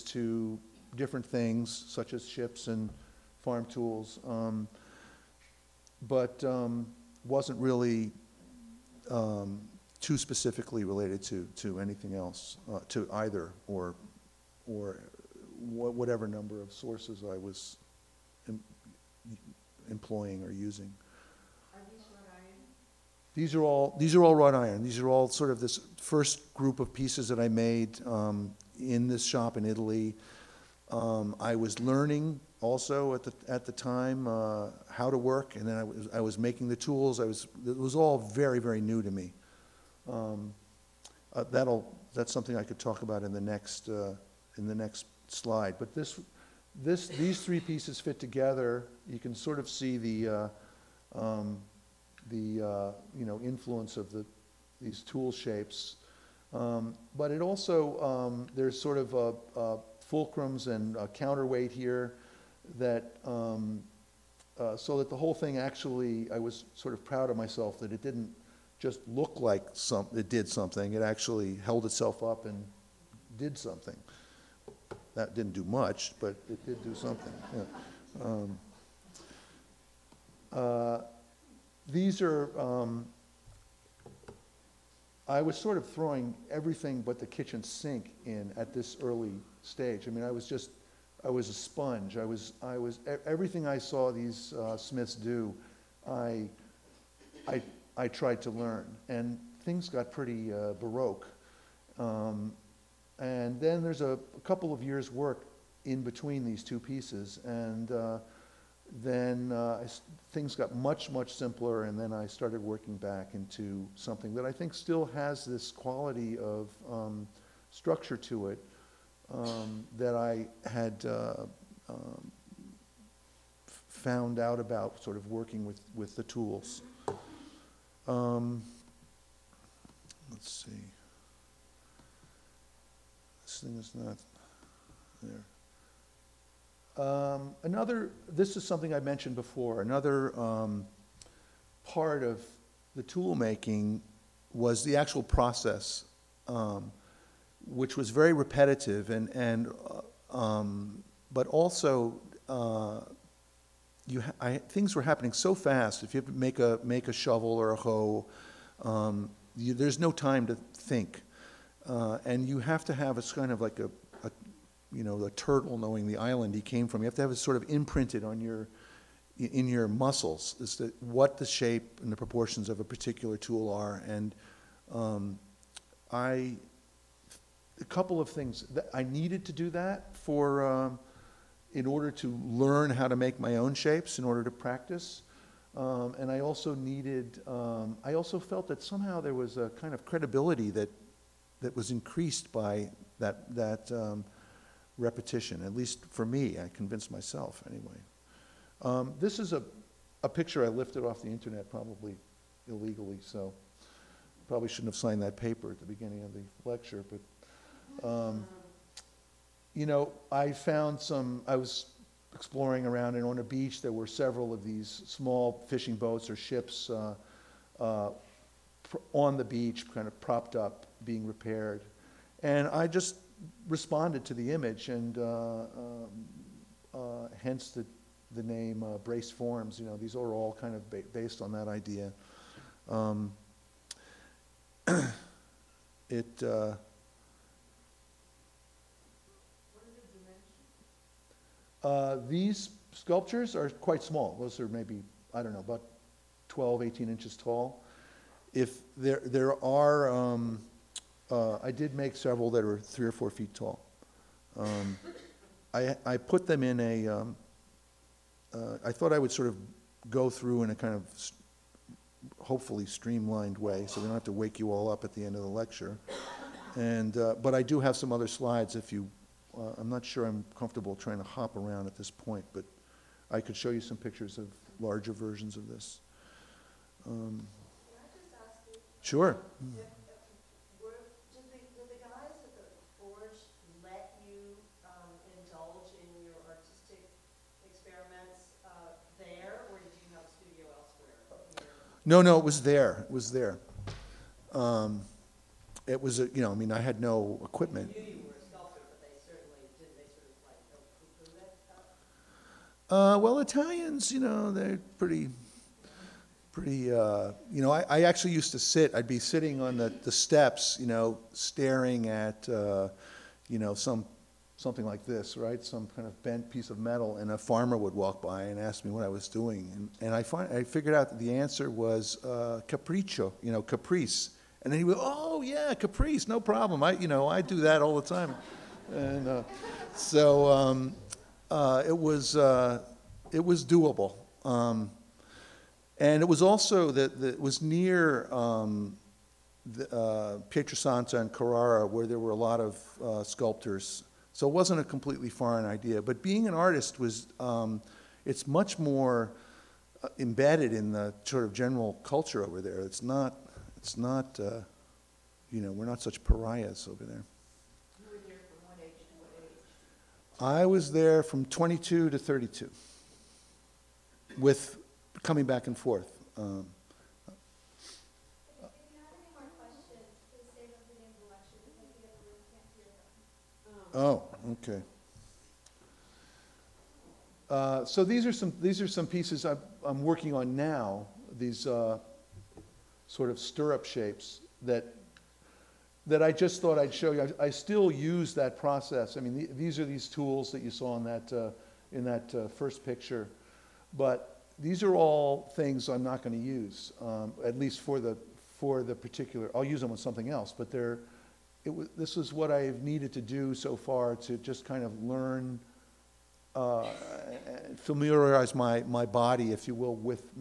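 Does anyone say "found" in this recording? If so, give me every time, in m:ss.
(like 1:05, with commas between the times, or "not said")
2:03, 3:30.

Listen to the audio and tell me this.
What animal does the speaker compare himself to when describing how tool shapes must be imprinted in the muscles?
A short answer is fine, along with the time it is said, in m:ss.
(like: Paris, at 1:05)
Turtle, at 2:45.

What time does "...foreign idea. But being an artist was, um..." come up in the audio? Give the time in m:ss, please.
5:45.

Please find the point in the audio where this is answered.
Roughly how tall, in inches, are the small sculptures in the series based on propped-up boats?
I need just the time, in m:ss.
4:06.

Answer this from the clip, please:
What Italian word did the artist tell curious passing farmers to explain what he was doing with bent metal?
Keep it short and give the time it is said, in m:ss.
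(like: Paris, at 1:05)
Capriccio, at 5:22.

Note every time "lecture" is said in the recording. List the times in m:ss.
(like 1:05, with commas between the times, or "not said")
3:26, 4:25.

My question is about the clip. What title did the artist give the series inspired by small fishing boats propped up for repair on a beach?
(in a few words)
Brace Forms.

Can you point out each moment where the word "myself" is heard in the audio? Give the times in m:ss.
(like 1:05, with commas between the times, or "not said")
1:07, 3:17.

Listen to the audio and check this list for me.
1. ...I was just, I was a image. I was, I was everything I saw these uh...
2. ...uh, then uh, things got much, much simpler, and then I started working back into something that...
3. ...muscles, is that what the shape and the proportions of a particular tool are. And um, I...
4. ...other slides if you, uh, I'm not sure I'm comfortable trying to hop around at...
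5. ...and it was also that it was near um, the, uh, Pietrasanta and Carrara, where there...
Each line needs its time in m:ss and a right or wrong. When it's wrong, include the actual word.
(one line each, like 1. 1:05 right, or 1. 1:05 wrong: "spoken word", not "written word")
1. 1:30 wrong: "sponge", not "image"
2. 1:47 right
3. 2:49 right
4. 4:28 right
5. 5:35 right.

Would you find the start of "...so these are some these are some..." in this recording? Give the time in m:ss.
6:17.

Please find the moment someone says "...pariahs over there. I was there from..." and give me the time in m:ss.
5:56.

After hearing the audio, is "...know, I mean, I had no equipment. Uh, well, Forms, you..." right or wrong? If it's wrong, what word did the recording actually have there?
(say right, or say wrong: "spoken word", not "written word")
wrong: "Italians", not "Forms".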